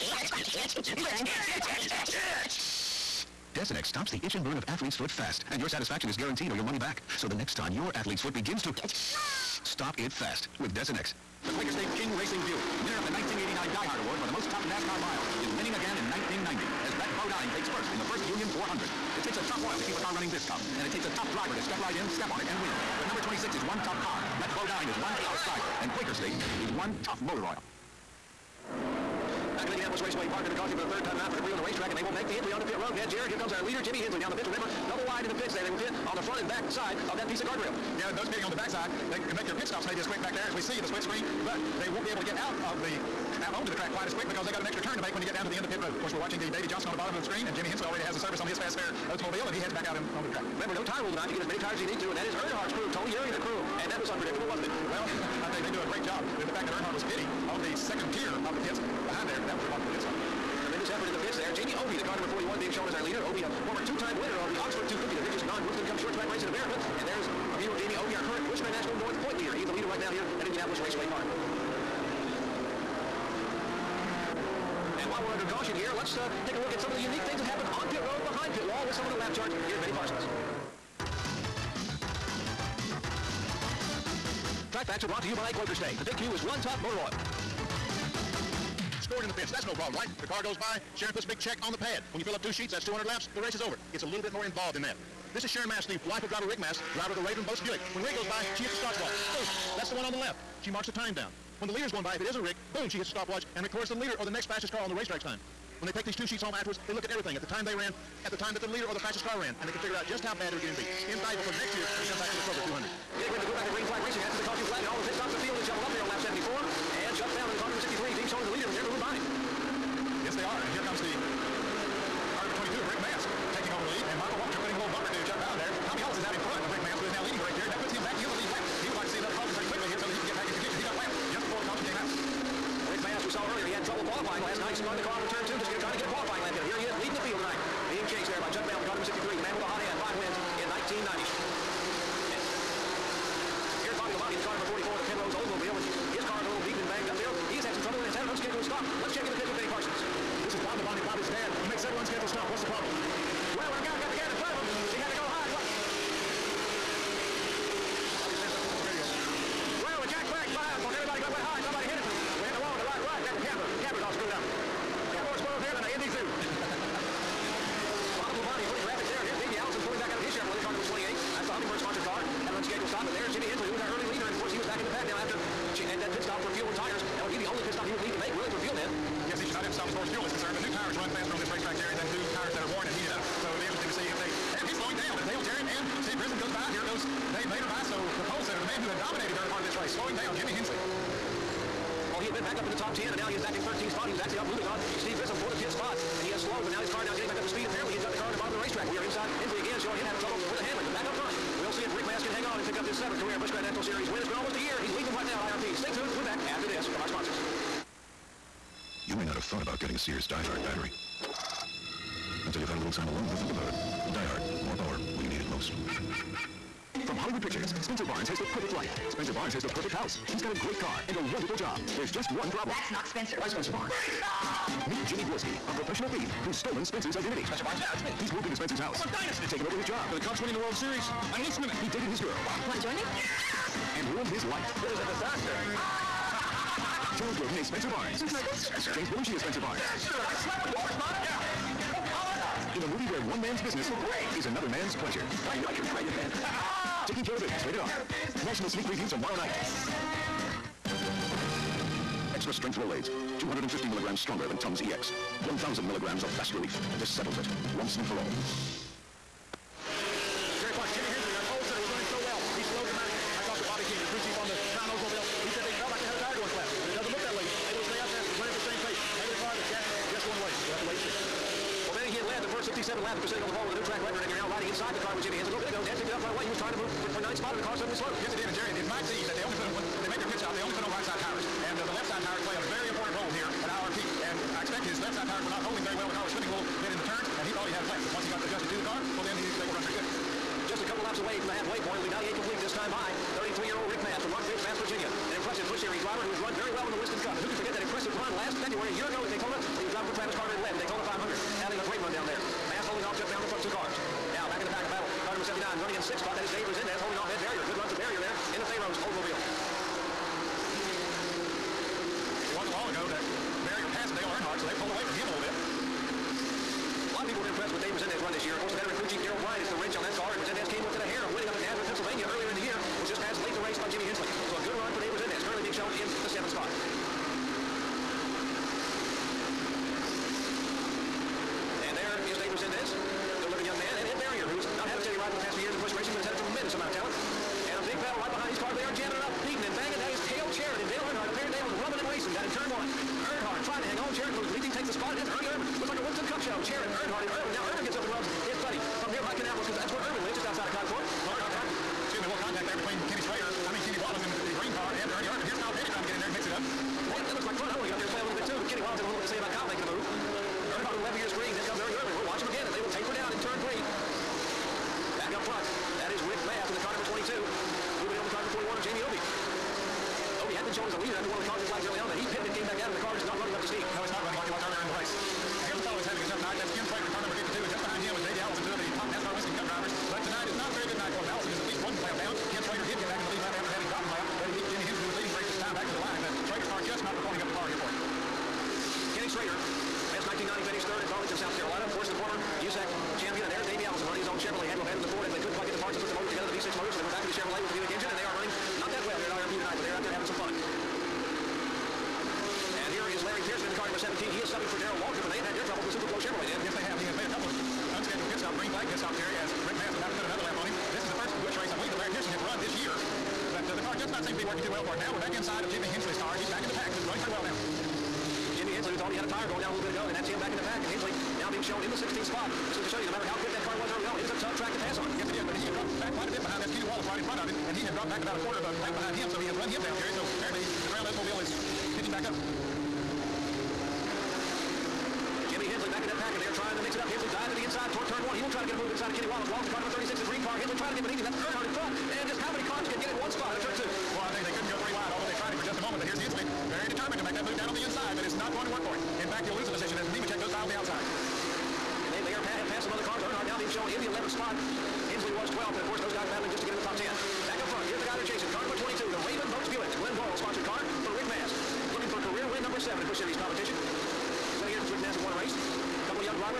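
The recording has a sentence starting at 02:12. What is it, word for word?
Rick Mast, we saw earlier, he had trouble qualifying last night.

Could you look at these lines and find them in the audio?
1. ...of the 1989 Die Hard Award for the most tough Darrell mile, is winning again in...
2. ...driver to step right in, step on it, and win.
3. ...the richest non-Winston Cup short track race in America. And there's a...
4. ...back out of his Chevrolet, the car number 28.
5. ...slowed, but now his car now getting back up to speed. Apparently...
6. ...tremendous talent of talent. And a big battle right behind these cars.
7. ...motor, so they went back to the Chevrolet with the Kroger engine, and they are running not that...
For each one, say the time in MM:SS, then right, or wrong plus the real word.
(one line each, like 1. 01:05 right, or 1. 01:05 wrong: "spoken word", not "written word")
1. 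00:12 wrong: "NASCAR", not "Darrell"
2. 00:21 right
3. 01:05 right
4. 02:49 right
5. 03:16 right
6. 05:36 wrong: "amount", not "talent"
7. 06:36 wrong: "Buick", not "Kroger".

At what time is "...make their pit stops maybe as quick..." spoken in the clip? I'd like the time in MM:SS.
00:39.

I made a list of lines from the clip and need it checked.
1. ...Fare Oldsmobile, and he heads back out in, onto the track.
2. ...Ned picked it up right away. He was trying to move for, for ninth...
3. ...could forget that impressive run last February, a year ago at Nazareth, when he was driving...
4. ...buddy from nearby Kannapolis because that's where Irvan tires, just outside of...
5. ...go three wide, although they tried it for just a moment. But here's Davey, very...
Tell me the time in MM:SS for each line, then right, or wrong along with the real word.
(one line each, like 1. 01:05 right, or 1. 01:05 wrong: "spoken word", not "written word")
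1. 00:48 right
2. 04:35 right
3. 04:57 wrong: "Daytona", not "Nazareth"
4. 05:48 wrong: "lives", not "tires"
5. 07:24 wrong: "Hensley", not "Davey".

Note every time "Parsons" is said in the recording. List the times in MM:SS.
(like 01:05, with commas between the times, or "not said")
01:19, 02:29.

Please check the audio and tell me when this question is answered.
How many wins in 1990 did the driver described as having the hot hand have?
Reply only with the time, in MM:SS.
02:20.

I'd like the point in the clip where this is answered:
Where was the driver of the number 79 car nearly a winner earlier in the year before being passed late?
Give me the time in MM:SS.
05:21.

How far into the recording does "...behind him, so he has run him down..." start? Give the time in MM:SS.
07:08.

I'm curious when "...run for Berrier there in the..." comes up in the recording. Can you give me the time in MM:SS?
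05:07.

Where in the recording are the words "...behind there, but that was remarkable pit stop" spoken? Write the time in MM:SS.
00:59.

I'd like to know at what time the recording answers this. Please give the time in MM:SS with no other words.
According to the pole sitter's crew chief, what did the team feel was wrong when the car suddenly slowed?
04:26.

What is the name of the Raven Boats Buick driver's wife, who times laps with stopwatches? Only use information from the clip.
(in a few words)
Sharon Mast.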